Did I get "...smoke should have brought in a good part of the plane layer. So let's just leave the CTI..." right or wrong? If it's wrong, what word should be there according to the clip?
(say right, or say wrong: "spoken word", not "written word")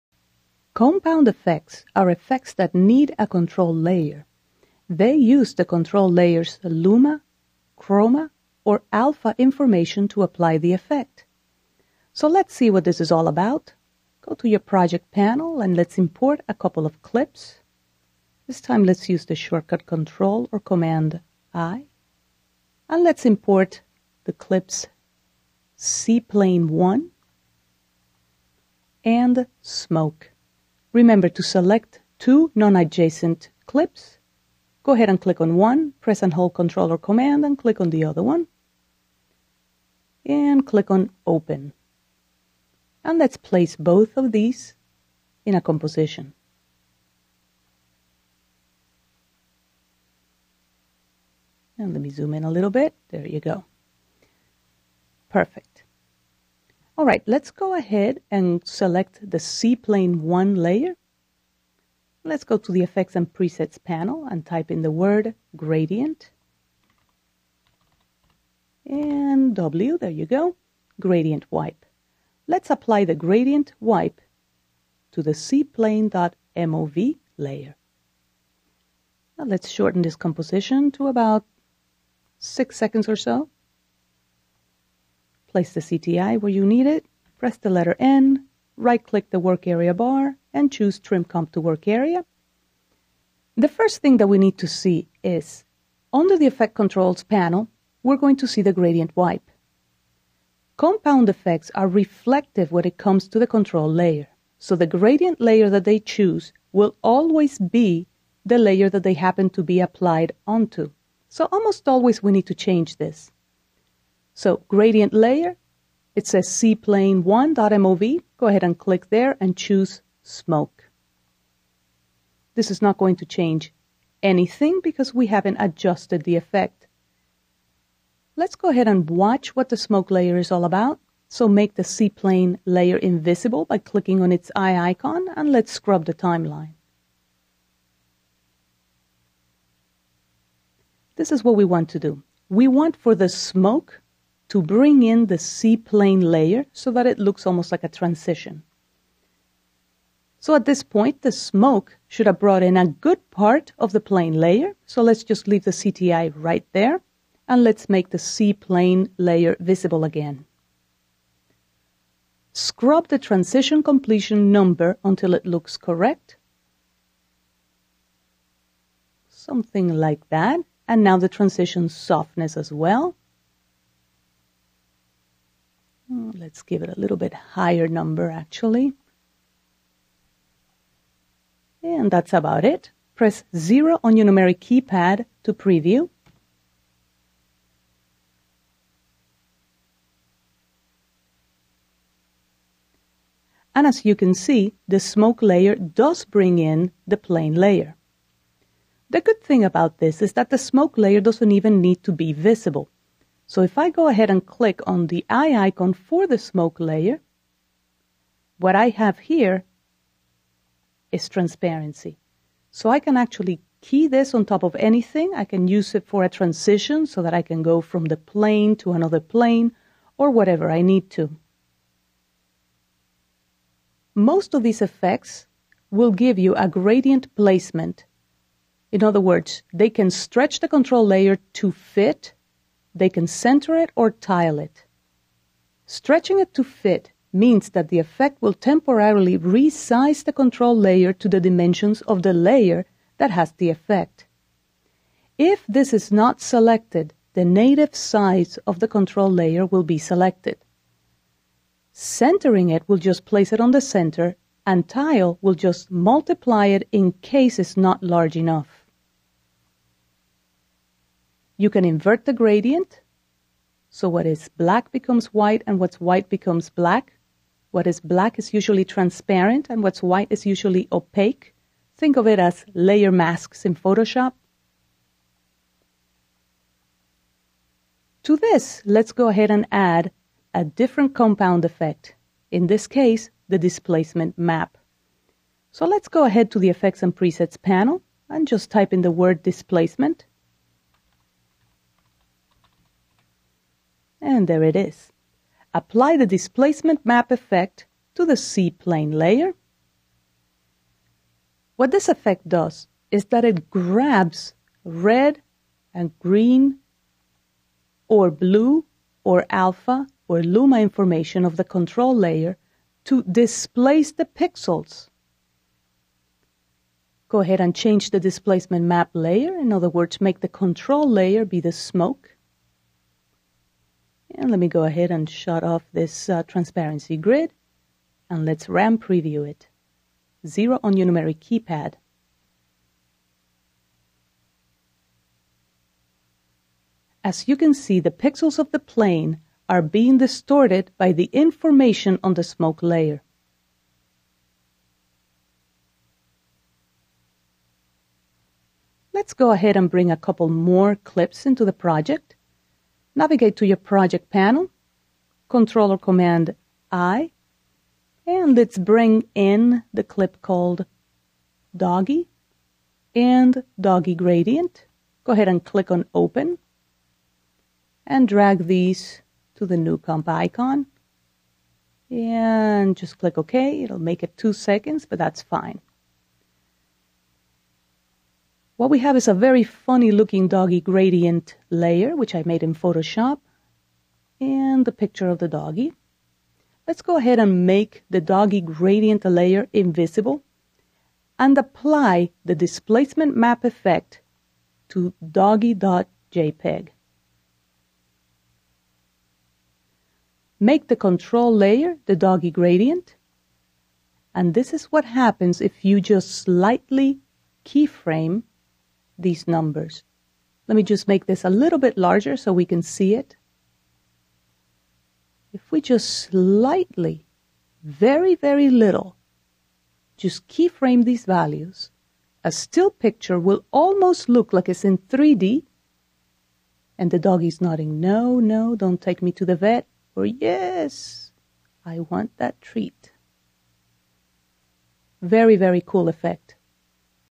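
right.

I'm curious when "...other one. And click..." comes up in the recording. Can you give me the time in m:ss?
0:38.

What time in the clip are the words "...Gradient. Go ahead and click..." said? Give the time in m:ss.
6:04.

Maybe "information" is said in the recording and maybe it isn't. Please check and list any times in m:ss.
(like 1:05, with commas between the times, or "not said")
0:09, 5:10, 5:41.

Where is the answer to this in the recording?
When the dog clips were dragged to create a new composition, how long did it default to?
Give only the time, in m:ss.
6:14.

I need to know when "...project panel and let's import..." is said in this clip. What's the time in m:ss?
0:14.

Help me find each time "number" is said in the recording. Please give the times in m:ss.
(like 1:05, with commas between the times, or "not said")
2:44, 2:57, 6:49.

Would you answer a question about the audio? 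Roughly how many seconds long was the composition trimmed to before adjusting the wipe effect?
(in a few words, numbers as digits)
6.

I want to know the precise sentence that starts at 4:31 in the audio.
Think of it as layer masks in Photoshop.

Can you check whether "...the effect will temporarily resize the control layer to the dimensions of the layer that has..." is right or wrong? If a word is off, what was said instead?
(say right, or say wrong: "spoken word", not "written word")
right.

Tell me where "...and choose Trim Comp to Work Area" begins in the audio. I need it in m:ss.
1:30.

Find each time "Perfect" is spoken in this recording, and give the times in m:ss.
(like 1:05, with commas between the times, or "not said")
0:55.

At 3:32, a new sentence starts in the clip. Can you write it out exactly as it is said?
So I can actually key this on top of anything.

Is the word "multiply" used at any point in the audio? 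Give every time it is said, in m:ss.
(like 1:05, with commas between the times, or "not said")
4:15.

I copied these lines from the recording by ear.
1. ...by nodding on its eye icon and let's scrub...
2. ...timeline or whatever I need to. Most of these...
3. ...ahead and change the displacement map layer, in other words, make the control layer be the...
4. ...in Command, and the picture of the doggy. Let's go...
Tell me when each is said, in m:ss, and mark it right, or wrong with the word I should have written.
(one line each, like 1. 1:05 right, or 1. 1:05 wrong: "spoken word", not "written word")
1. 2:13 wrong: "clicking", not "nodding"
2. 3:39 wrong: "plane", not "timeline"
3. 5:17 right
4. 6:22 wrong: "Photoshop", not "Command".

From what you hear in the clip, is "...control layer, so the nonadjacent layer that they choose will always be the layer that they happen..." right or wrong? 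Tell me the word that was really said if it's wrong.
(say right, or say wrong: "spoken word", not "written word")
wrong: "gradient", not "nonadjacent".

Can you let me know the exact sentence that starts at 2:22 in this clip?
We want for the smoke to bring in the seaplane layer so that it looks almost like a transition.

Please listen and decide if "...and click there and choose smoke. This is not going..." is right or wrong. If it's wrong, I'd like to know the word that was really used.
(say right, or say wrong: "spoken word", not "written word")
right.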